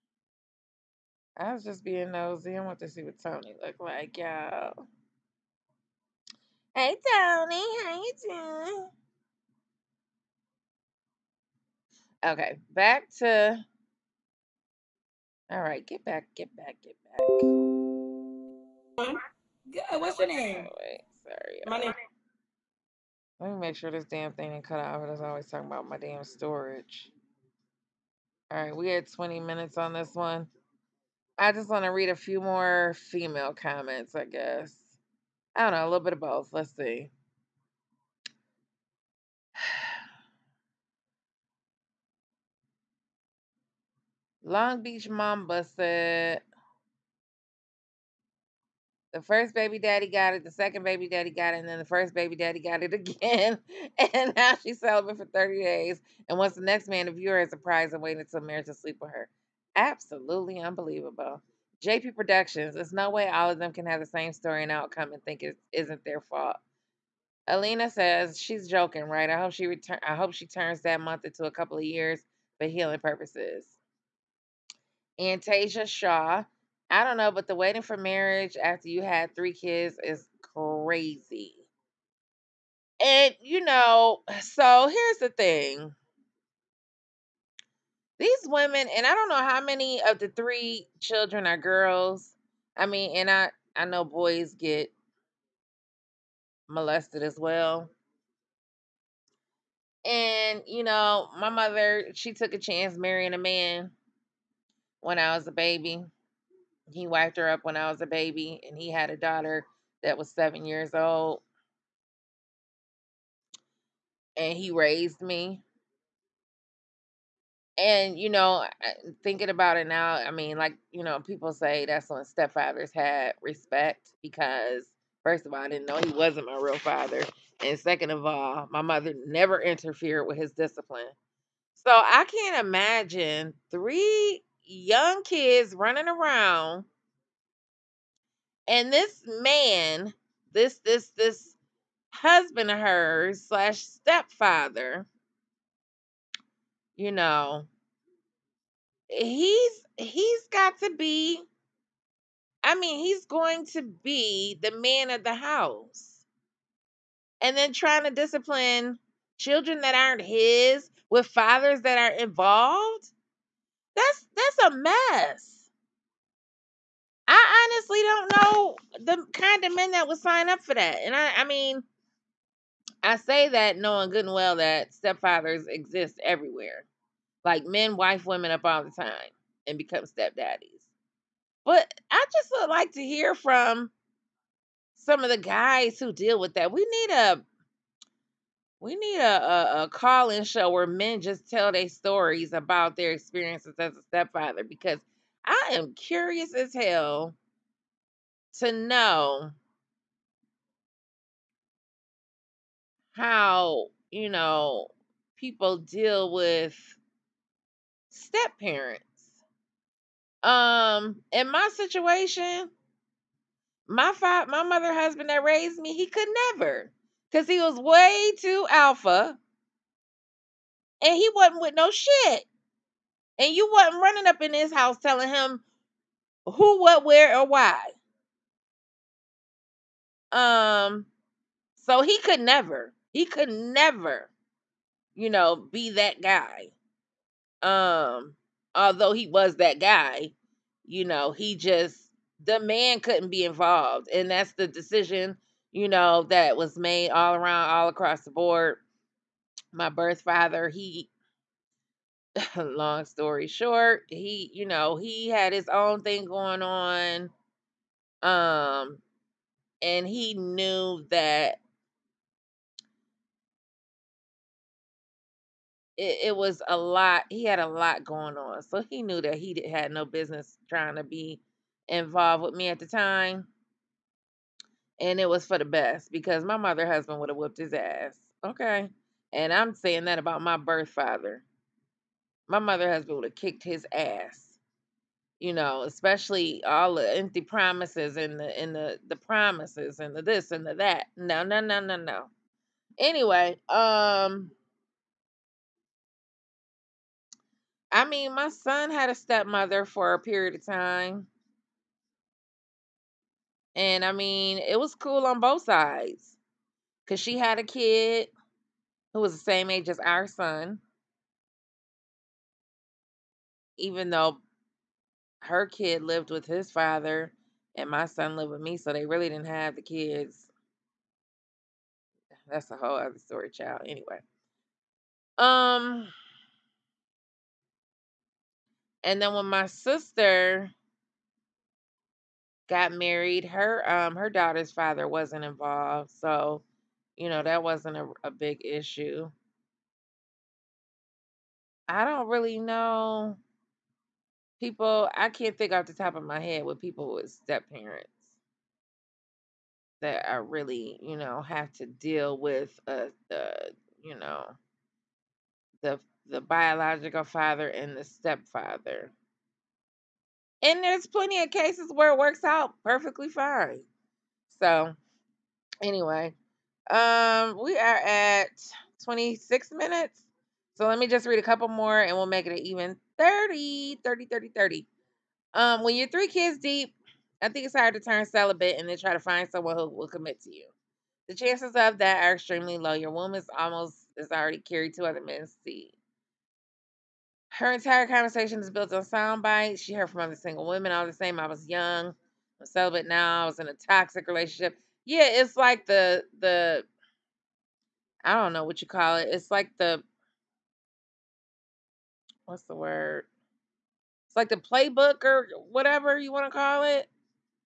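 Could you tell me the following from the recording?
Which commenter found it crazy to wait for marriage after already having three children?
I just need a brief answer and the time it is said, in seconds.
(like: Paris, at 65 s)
Antasia Shaw, at 75 s.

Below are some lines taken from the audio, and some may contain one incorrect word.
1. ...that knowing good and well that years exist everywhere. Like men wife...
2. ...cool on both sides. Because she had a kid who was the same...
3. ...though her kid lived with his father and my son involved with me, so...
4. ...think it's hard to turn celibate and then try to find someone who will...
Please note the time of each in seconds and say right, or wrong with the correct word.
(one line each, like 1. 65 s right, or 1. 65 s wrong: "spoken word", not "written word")
1. 173 s wrong: "stepfathers", not "years"
2. 304 s right
3. 314 s wrong: "lived", not "involved"
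4. 377 s right.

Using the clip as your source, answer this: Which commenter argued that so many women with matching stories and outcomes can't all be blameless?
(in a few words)
JP Productions.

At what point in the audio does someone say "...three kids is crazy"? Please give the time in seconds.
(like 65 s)
79 s.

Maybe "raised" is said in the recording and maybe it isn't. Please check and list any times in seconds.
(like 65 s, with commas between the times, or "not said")
114 s, 215 s.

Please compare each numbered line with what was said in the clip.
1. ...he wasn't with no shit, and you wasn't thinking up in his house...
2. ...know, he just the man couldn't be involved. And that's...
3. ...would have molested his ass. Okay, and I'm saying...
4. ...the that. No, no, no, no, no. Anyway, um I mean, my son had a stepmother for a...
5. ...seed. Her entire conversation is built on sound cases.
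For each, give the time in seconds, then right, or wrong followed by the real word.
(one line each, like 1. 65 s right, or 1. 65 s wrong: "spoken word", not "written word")
1. 221 s wrong: "running", not "thinking"
2. 241 s right
3. 277 s wrong: "whooped", not "molested"
4. 290 s right
5. 385 s wrong: "bites", not "cases".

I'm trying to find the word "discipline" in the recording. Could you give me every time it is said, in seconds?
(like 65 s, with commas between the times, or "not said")
130 s, 158 s.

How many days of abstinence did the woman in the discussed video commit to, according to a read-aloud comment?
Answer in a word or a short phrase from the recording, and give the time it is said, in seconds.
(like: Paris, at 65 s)
30, at 55 s.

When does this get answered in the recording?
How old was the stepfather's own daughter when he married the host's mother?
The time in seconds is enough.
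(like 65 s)
110 s.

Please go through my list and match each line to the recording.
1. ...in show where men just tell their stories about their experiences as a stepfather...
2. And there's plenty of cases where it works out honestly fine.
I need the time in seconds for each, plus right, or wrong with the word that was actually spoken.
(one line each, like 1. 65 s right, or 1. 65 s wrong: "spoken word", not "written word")
1. 190 s right
2. 360 s wrong: "perfectly", not "honestly".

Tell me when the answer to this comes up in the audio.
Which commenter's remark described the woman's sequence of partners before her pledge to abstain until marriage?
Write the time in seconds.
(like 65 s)
44 s.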